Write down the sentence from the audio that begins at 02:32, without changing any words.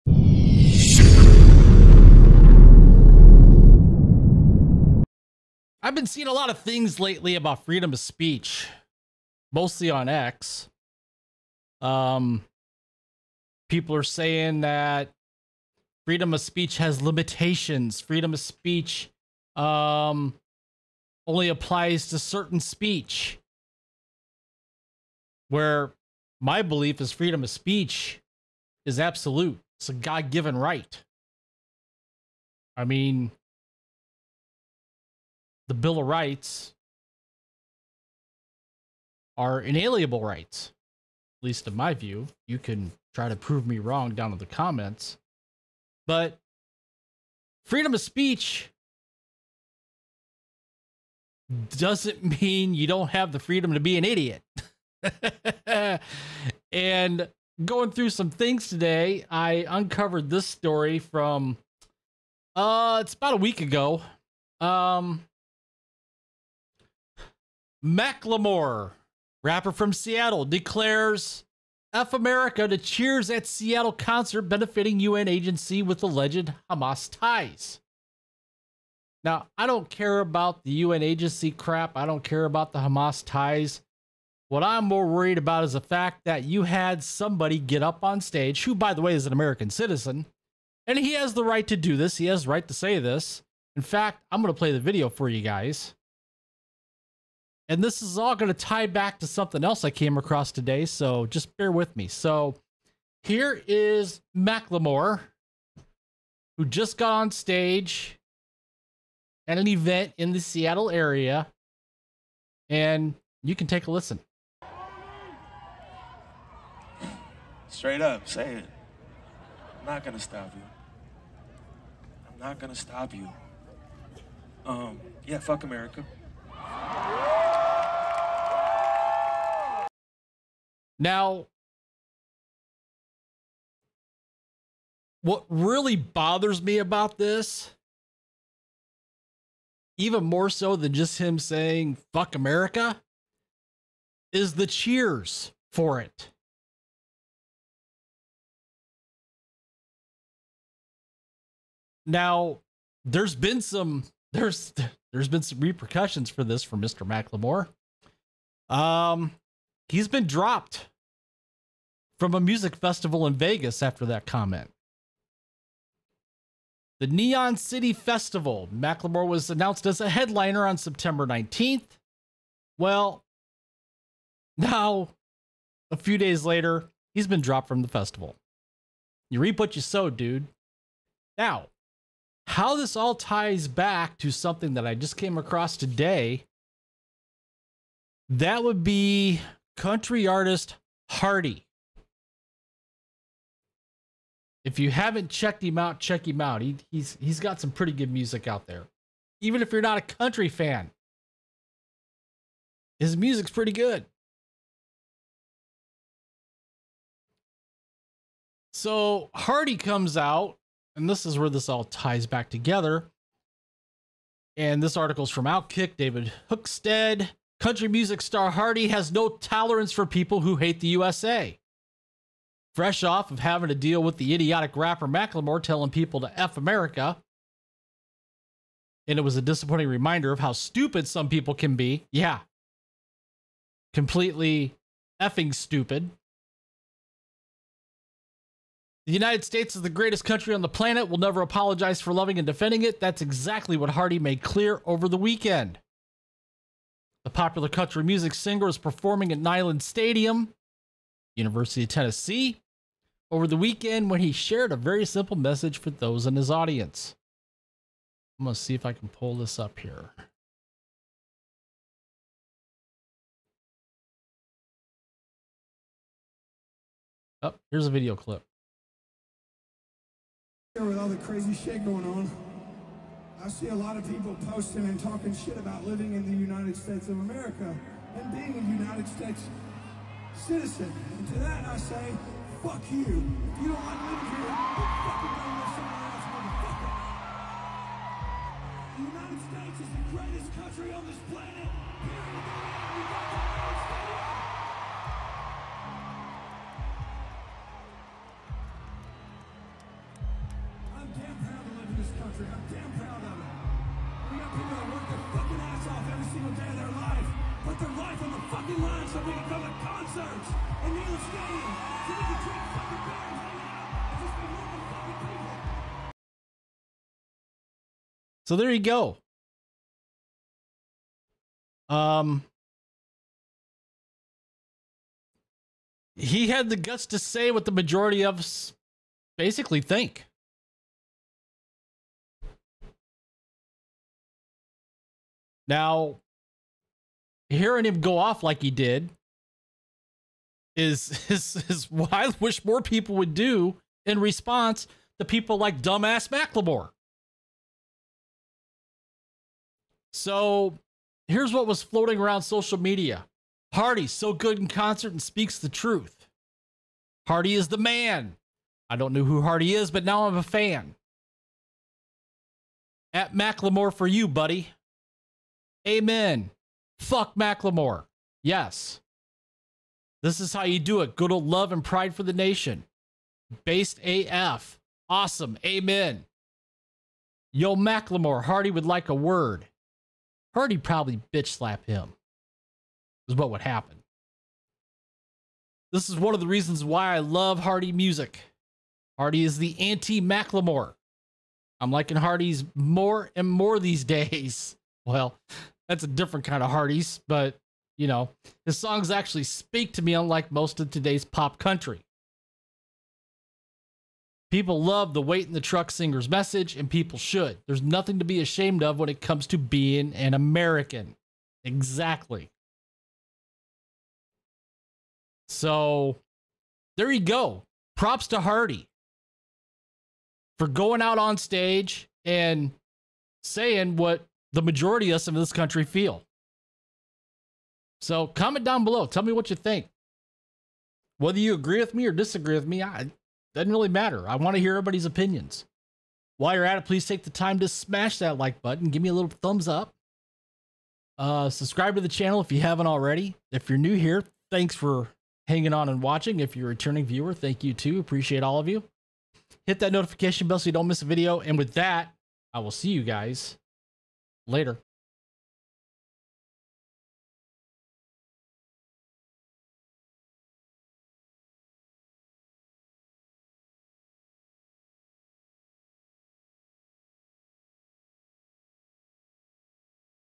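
Now, there's been some there's there's been some repercussions for this for Mr.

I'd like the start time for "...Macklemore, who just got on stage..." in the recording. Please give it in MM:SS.
01:44.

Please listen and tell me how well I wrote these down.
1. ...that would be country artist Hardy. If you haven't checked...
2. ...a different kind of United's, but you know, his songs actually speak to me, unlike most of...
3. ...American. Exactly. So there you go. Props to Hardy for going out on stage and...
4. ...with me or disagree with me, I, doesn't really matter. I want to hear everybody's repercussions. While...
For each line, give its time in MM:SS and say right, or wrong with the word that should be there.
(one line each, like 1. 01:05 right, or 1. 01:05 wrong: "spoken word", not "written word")
1. 03:08 right
2. 06:36 wrong: "Hardy", not "United"
3. 06:50 right
4. 07:11 wrong: "opinions", not "repercussions".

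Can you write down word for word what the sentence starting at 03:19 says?
Even if you're not a country fan, his music's pretty good.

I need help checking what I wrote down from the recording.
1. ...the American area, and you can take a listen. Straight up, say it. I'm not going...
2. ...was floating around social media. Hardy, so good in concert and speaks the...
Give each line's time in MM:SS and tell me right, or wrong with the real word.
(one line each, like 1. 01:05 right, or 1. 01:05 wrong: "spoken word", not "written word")
1. 01:50 wrong: "Seattle", not "American"
2. 05:51 right.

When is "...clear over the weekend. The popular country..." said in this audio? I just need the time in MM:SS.
04:04.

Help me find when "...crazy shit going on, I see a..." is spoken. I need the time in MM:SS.
04:31.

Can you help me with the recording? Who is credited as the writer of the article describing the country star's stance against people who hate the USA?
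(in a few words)
David Hookstead.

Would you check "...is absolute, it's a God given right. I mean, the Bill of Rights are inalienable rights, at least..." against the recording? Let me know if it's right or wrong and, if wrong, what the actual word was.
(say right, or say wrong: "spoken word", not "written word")
right.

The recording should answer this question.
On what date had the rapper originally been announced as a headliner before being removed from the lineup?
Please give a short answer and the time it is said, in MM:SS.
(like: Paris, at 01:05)
September 19, at 02:50.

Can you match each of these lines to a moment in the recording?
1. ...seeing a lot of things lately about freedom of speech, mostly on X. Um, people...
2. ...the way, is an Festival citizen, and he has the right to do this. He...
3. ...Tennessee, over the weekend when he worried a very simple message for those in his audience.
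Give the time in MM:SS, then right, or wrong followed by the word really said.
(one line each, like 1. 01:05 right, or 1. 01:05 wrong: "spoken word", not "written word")
1. 00:06 right
2. 01:28 wrong: "American", not "Festival"
3. 04:11 wrong: "shared", not "worried".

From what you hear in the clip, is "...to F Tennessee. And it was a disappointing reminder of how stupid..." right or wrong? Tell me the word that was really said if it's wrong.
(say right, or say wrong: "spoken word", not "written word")
wrong: "America", not "Tennessee".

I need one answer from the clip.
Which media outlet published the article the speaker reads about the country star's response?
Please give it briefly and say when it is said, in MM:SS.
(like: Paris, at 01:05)
Outkick, at 03:35.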